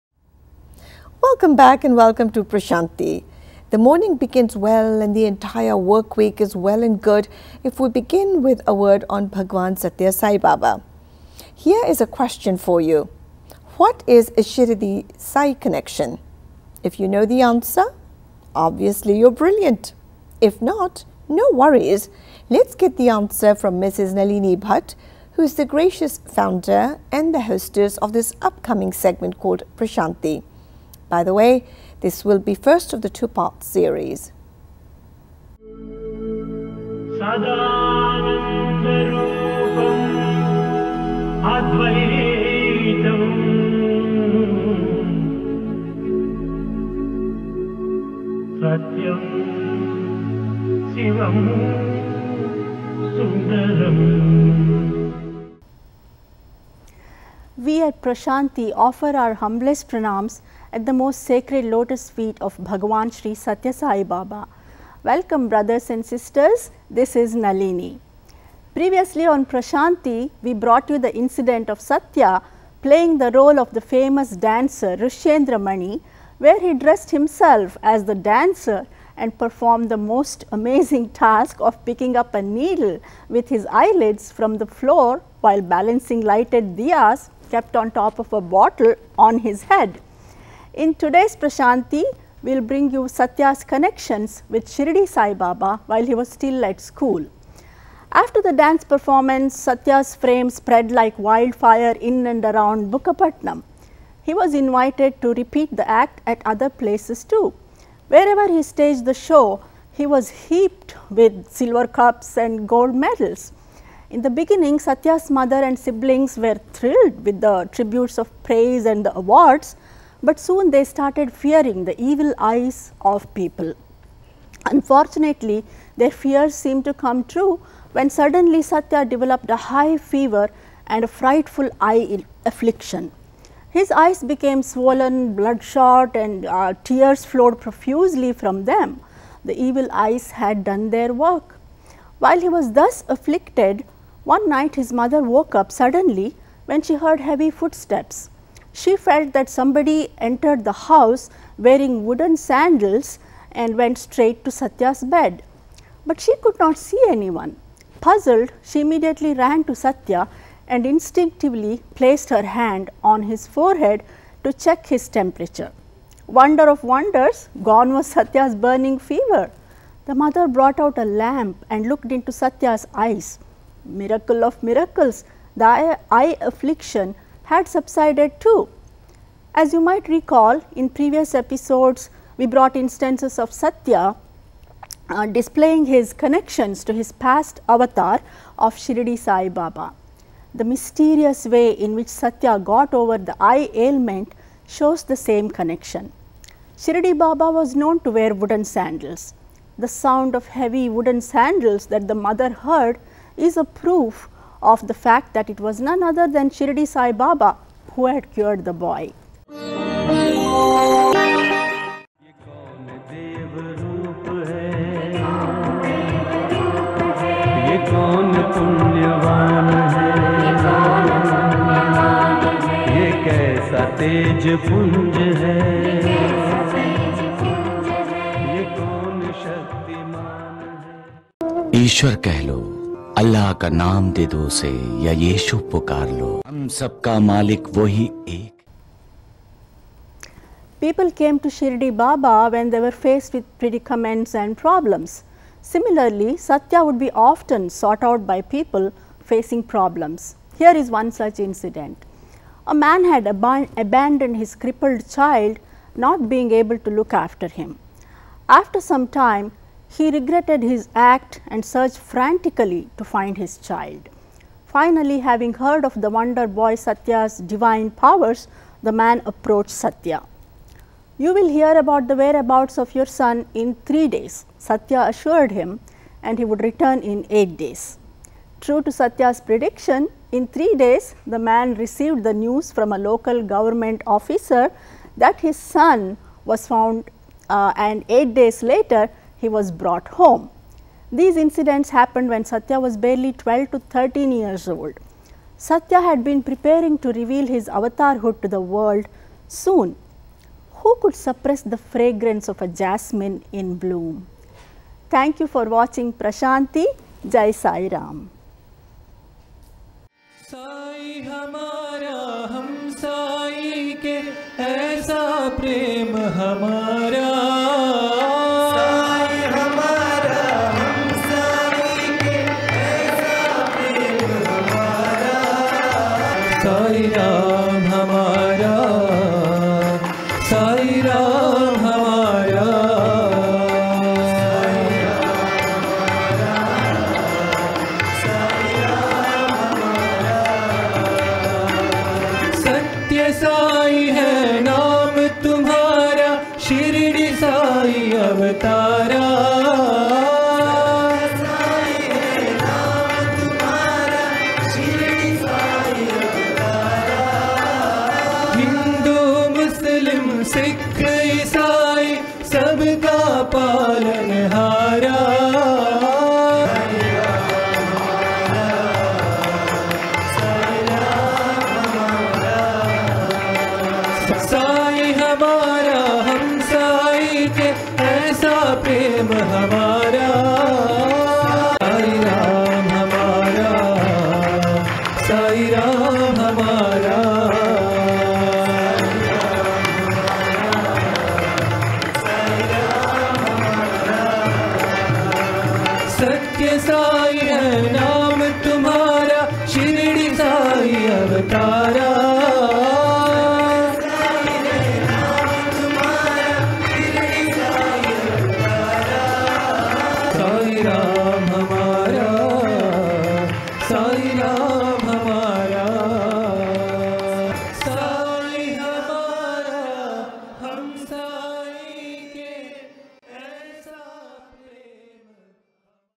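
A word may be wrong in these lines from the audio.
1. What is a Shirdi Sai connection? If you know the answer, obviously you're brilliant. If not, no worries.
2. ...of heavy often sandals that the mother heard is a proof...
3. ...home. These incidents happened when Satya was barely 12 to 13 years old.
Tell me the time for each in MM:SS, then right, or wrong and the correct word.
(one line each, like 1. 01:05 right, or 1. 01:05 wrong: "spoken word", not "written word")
1. 00:13 right
2. 03:20 wrong: "wooden", not "often"
3. 04:50 right.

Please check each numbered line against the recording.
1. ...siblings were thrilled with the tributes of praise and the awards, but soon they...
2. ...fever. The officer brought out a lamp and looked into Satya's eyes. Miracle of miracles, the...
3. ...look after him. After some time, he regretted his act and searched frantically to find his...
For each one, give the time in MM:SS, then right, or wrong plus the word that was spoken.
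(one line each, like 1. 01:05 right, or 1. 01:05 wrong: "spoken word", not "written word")
1. 01:55 right
2. 02:48 wrong: "mother", not "officer"
3. 04:17 right.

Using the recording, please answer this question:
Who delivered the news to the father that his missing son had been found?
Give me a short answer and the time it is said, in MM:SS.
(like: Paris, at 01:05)
A local government officer, at 04:42.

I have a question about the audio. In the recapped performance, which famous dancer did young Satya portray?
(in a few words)
Rishendramani.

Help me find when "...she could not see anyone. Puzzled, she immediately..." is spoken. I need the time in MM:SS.
02:36.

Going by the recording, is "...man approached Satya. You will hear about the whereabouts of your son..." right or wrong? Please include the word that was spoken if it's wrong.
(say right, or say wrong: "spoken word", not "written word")
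right.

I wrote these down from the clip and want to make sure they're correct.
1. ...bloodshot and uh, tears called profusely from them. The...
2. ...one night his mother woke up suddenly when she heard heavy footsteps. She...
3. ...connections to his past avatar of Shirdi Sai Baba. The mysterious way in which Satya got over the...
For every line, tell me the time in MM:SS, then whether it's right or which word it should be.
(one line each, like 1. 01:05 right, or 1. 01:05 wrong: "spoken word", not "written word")
1. 02:15 wrong: "flowed", not "called"
2. 02:24 right
3. 03:06 right.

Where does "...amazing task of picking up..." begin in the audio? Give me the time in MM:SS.
01:20.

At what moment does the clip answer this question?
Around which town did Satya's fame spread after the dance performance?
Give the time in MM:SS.
01:42.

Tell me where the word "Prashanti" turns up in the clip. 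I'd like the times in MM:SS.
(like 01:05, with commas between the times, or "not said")
00:02, 00:29, 00:58, 01:09, 01:31, 05:06.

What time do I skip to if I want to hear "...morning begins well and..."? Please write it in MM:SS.
00:03.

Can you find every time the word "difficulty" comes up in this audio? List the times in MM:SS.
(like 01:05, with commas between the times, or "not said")
not said.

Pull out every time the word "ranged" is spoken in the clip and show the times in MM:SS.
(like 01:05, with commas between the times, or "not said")
not said.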